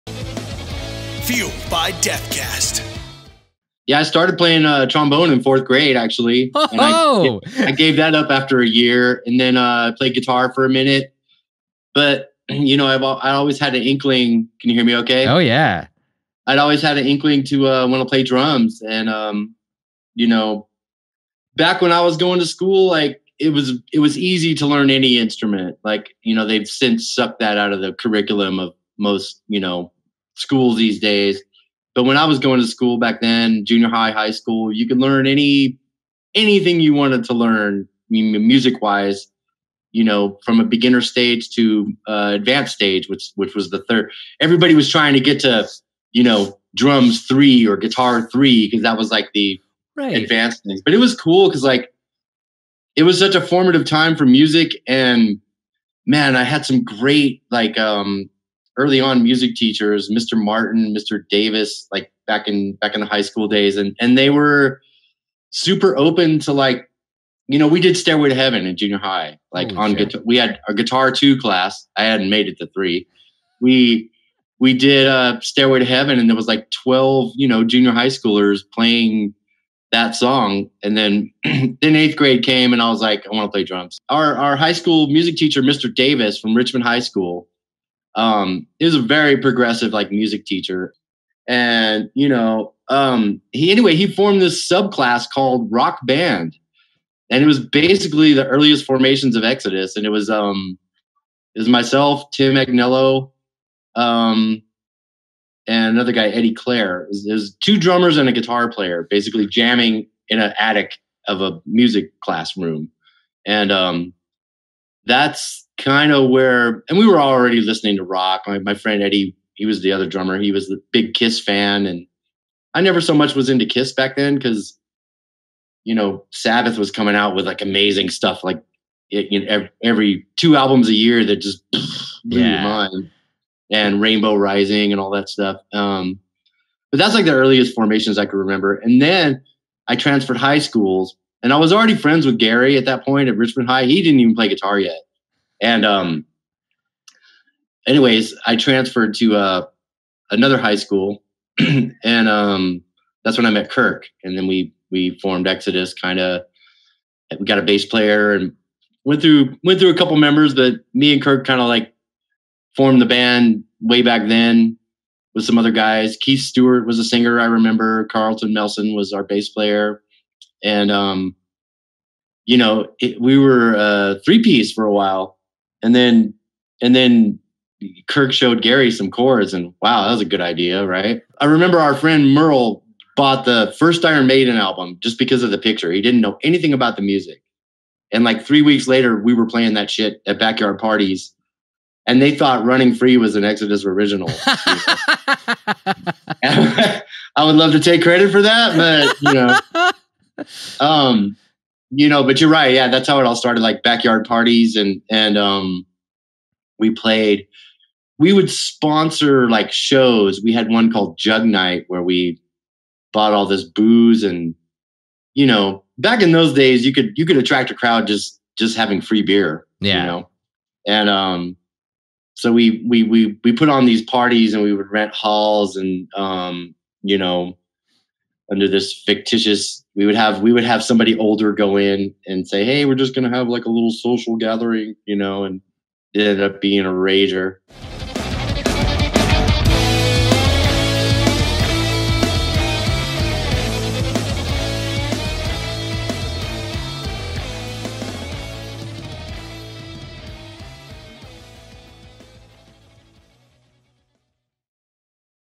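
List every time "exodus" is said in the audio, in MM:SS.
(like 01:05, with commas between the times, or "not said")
01:39, 02:35, 03:13.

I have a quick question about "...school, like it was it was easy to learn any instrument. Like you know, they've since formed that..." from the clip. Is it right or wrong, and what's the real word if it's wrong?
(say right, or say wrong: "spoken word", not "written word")
wrong: "sucked", not "formed".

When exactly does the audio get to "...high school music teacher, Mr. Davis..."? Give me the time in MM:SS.
01:24.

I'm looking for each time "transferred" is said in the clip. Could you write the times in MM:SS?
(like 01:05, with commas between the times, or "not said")
02:19, 02:28.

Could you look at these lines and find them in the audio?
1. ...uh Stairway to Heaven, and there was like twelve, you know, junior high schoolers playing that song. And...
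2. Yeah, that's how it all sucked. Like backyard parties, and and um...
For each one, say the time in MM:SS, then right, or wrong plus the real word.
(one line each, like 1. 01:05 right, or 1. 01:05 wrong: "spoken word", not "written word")
1. 01:15 right
2. 03:22 wrong: "started", not "sucked".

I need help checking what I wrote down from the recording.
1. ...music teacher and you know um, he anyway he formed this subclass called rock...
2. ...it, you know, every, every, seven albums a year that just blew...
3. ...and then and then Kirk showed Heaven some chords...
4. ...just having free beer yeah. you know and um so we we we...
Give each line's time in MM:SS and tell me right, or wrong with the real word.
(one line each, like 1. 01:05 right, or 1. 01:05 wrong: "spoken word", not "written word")
1. 01:30 right
2. 02:09 wrong: "two", not "seven"
3. 02:55 wrong: "Gary", not "Heaven"
4. 03:38 right.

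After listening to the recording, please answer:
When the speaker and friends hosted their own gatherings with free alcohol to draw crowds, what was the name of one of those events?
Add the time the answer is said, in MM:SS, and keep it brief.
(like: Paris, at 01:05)
Jug Night, at 03:31.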